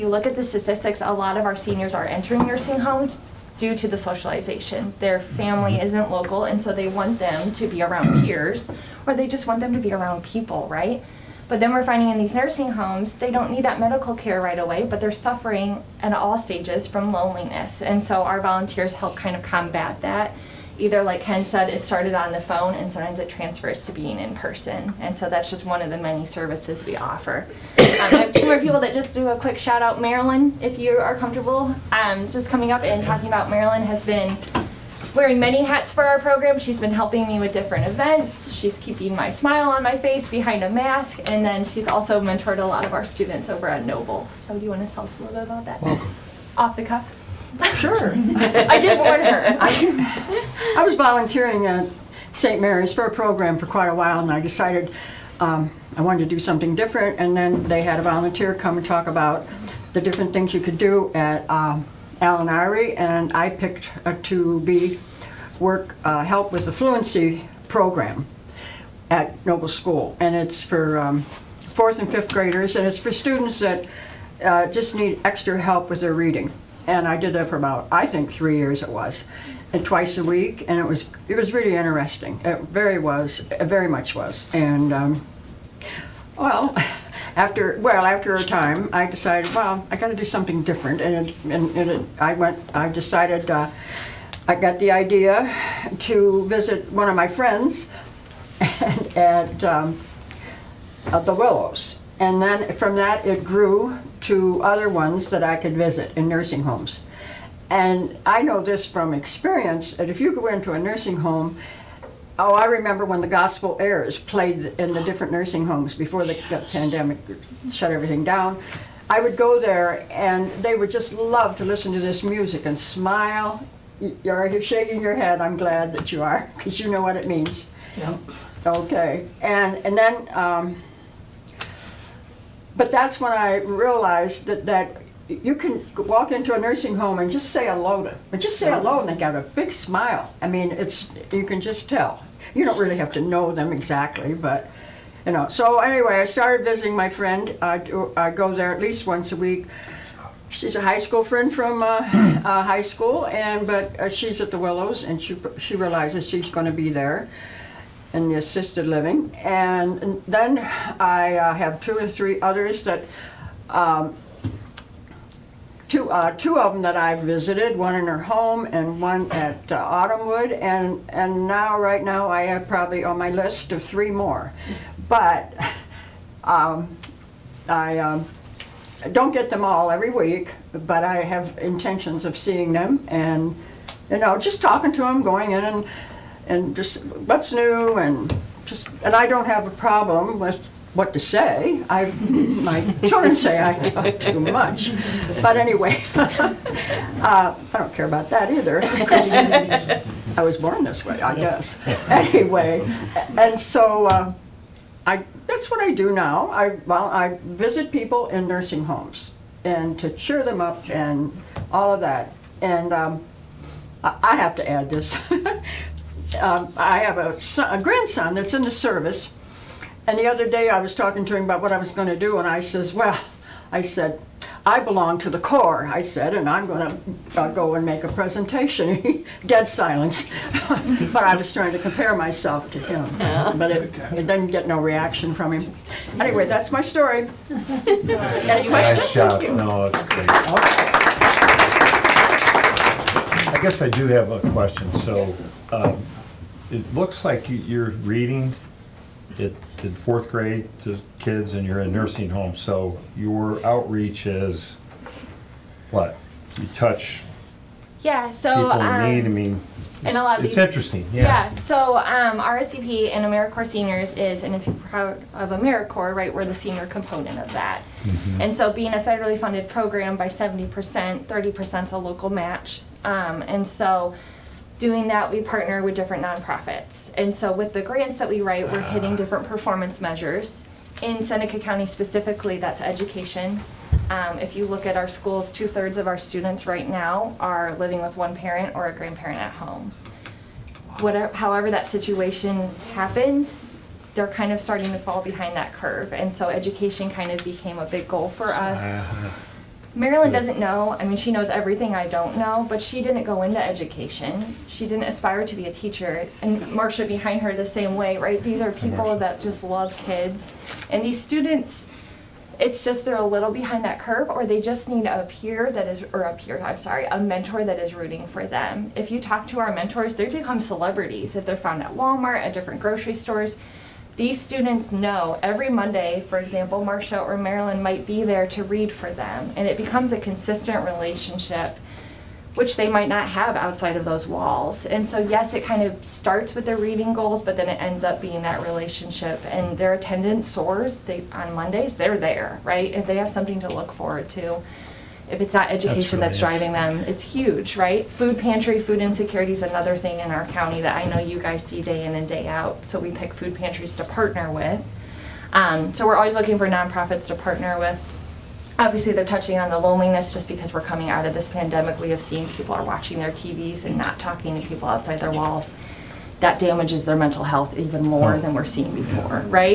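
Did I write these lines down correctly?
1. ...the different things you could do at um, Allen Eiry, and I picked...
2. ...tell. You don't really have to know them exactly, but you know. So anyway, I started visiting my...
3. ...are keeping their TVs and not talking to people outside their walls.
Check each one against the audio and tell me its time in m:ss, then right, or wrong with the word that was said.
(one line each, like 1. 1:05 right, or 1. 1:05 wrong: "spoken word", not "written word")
1. 0:59 right
2. 2:21 right
3. 6:02 wrong: "watching", not "keeping".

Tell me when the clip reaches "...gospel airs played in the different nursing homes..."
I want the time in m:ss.
1:53.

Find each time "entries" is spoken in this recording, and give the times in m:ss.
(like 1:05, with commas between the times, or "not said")
not said.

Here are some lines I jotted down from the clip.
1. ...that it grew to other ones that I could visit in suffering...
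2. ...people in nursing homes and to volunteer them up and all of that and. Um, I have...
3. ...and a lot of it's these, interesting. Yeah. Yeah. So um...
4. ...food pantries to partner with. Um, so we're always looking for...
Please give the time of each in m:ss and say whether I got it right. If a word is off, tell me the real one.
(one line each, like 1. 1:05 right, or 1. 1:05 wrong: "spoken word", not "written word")
1. 1:42 wrong: "nursing", not "suffering"
2. 3:27 wrong: "cheer", not "volunteer"
3. 4:20 right
4. 5:53 right.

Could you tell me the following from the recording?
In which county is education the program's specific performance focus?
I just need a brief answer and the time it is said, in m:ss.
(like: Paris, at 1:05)
Seneca County, at 4:41.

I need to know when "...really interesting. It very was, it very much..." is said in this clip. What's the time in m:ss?
1:21.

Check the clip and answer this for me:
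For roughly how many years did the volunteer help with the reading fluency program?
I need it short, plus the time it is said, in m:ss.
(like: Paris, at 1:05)
3, at 1:18.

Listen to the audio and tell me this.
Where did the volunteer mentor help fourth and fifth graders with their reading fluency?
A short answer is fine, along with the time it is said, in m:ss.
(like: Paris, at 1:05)
Noble School, at 1:09.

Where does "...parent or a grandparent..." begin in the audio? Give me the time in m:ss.
4:48.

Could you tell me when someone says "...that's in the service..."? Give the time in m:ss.
3:38.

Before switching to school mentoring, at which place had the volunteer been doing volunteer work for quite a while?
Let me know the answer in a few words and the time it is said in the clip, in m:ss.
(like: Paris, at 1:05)
St. Mary's, at 0:52.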